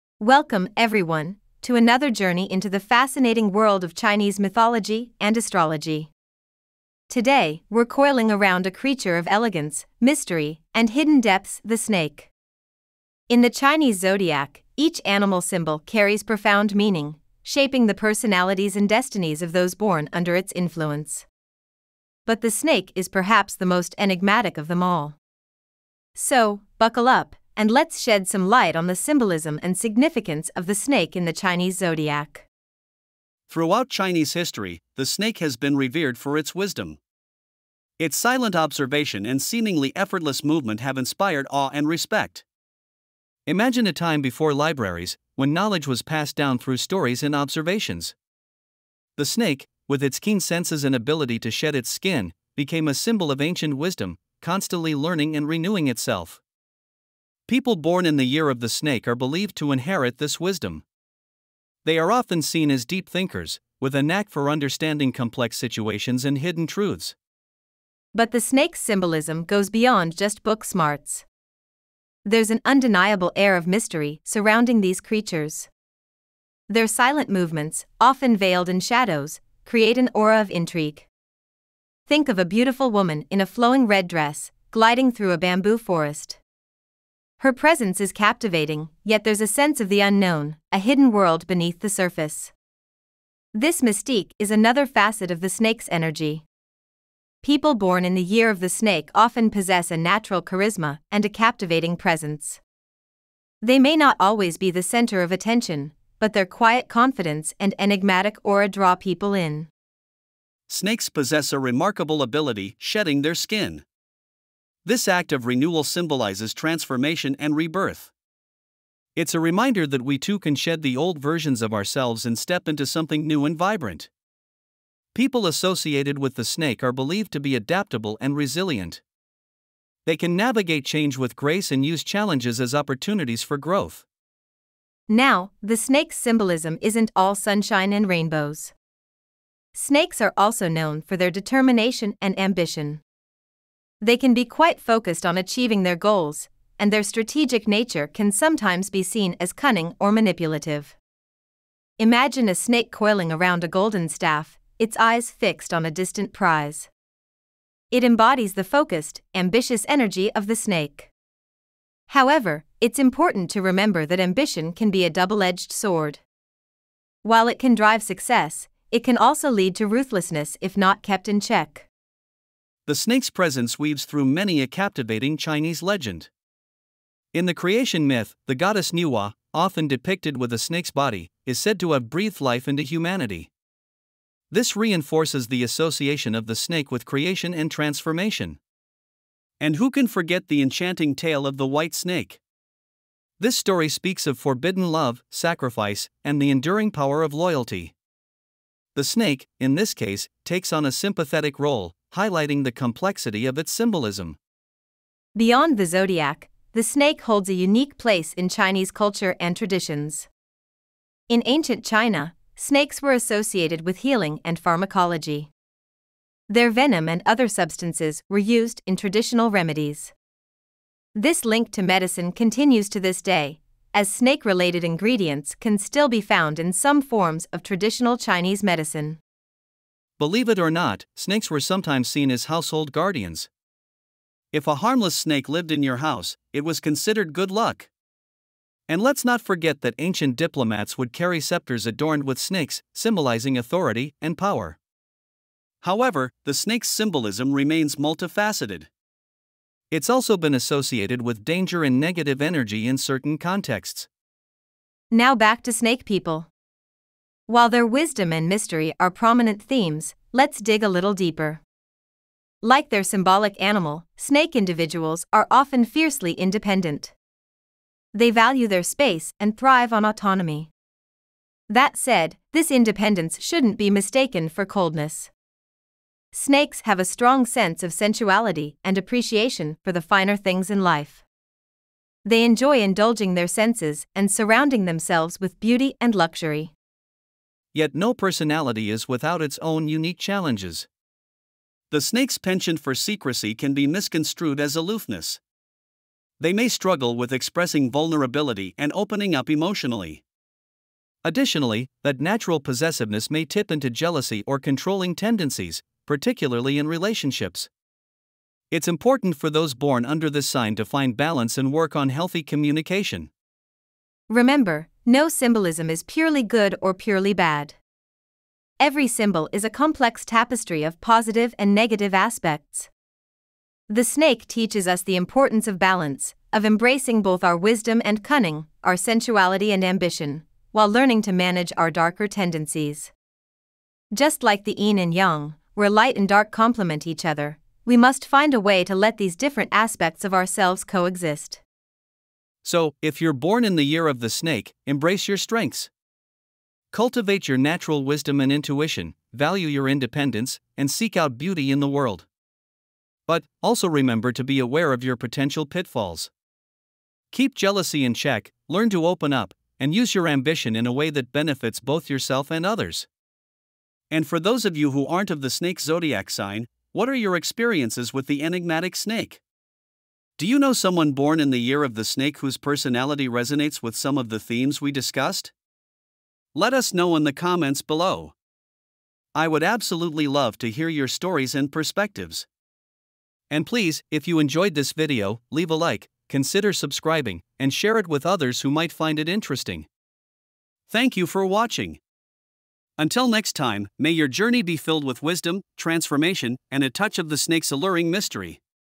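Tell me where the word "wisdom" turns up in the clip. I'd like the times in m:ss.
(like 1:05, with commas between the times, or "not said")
0:36, 0:53, 1:00, 4:17, 5:27, 5:48, 6:35.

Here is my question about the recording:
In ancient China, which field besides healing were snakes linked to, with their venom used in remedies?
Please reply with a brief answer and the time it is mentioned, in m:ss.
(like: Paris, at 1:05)
Pharmacology, at 3:34.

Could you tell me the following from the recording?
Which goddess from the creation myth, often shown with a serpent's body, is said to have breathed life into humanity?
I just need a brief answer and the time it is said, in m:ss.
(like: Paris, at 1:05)
Nuwa, at 2:58.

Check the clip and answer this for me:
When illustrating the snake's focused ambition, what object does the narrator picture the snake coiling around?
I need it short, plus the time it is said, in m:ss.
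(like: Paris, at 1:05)
Golden staff, at 2:33.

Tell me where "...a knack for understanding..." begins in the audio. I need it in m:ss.
1:03.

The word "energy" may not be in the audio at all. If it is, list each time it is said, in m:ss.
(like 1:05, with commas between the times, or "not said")
1:35, 2:39, 4:12.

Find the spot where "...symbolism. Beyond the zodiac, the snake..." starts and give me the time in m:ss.
3:23.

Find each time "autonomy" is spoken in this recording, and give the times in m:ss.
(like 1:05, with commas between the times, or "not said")
4:30.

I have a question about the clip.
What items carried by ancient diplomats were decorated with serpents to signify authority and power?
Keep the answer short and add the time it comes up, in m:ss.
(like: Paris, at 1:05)
Scepters, at 4:01.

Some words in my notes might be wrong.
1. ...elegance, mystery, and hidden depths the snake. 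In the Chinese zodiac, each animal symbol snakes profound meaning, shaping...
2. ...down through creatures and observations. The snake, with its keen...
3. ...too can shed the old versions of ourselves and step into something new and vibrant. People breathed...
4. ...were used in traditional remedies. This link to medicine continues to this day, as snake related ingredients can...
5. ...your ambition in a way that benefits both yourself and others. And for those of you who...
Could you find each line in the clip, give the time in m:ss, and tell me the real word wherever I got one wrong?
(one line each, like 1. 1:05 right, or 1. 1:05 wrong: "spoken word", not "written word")
1. 0:09 wrong: "carries", not "snakes"
2. 0:46 wrong: "stories", not "creatures"
3. 2:00 wrong: "associated", not "breathed"
4. 3:38 right
5. 6:00 right.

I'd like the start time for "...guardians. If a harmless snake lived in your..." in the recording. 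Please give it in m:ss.
3:52.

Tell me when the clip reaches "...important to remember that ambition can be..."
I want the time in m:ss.
2:42.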